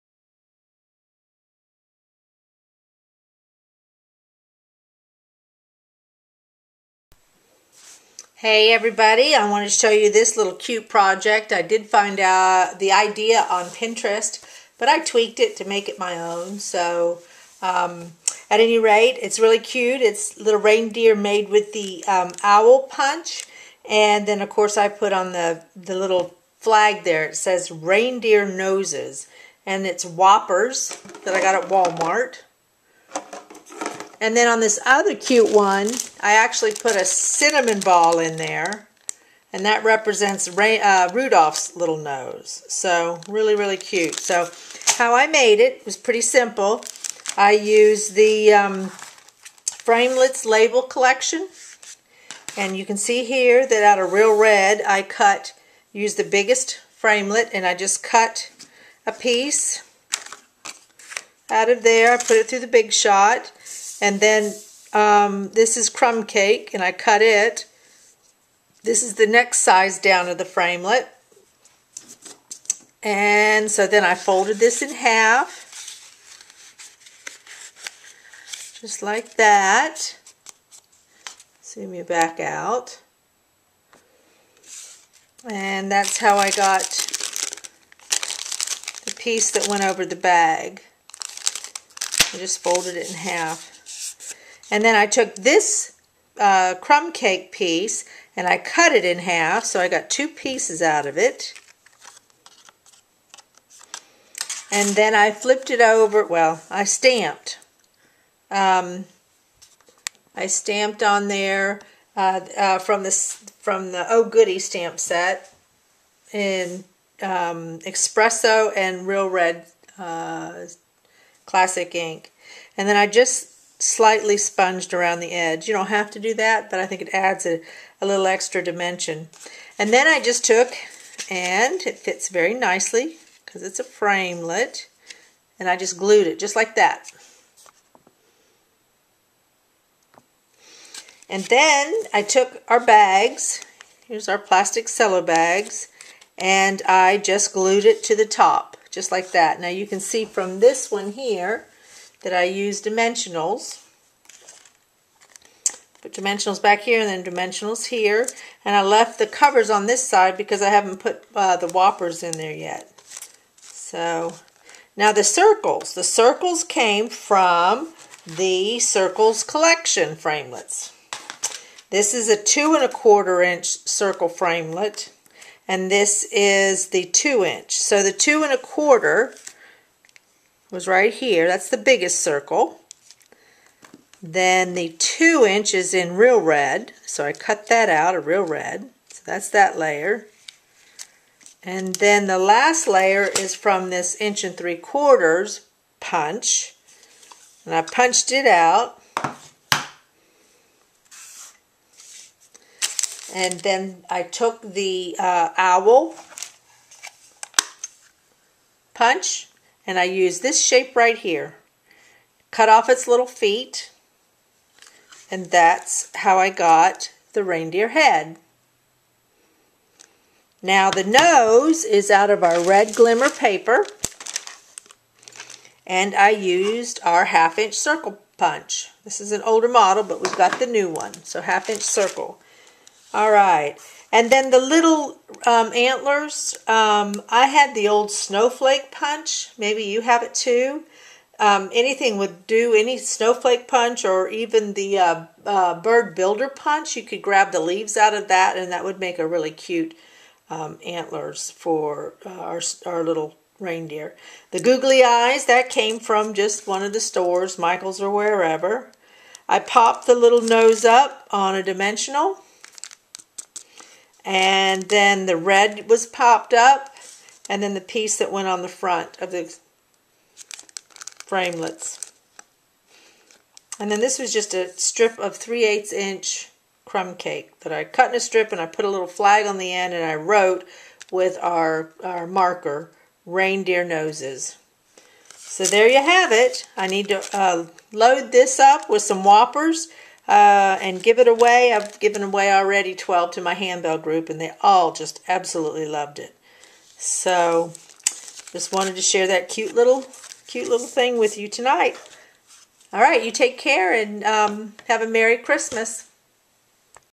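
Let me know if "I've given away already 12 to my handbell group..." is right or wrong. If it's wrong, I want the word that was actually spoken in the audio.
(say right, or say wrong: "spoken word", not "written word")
right.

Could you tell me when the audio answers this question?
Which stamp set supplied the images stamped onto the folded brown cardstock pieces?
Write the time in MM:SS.
01:54.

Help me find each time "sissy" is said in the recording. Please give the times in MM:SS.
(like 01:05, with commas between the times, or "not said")
not said.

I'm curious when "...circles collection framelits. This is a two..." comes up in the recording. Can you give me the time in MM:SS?
02:48.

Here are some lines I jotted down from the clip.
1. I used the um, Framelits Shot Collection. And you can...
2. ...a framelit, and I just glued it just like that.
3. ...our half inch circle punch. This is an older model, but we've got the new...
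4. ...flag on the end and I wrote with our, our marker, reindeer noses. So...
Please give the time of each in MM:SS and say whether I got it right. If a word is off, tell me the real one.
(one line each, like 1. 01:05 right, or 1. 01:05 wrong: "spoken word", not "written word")
1. 00:47 wrong: "Label", not "Shot"
2. 02:13 right
3. 03:47 right
4. 04:39 right.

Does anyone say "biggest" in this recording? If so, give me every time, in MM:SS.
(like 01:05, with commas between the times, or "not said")
00:56, 03:01.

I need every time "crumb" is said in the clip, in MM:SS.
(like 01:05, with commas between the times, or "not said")
01:05, 01:36, 04:36.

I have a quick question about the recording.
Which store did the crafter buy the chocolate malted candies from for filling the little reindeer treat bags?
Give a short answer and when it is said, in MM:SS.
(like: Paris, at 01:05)
Walmart, at 00:31.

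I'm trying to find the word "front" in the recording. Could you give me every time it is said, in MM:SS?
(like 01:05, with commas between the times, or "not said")
04:28.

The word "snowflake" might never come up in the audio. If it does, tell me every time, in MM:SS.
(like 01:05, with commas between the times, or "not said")
03:58, 04:02.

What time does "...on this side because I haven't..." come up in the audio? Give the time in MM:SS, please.
02:39.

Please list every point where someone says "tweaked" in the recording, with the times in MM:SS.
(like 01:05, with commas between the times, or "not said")
00:14.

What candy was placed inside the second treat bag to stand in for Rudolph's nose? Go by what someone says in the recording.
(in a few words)
cinnamon ball.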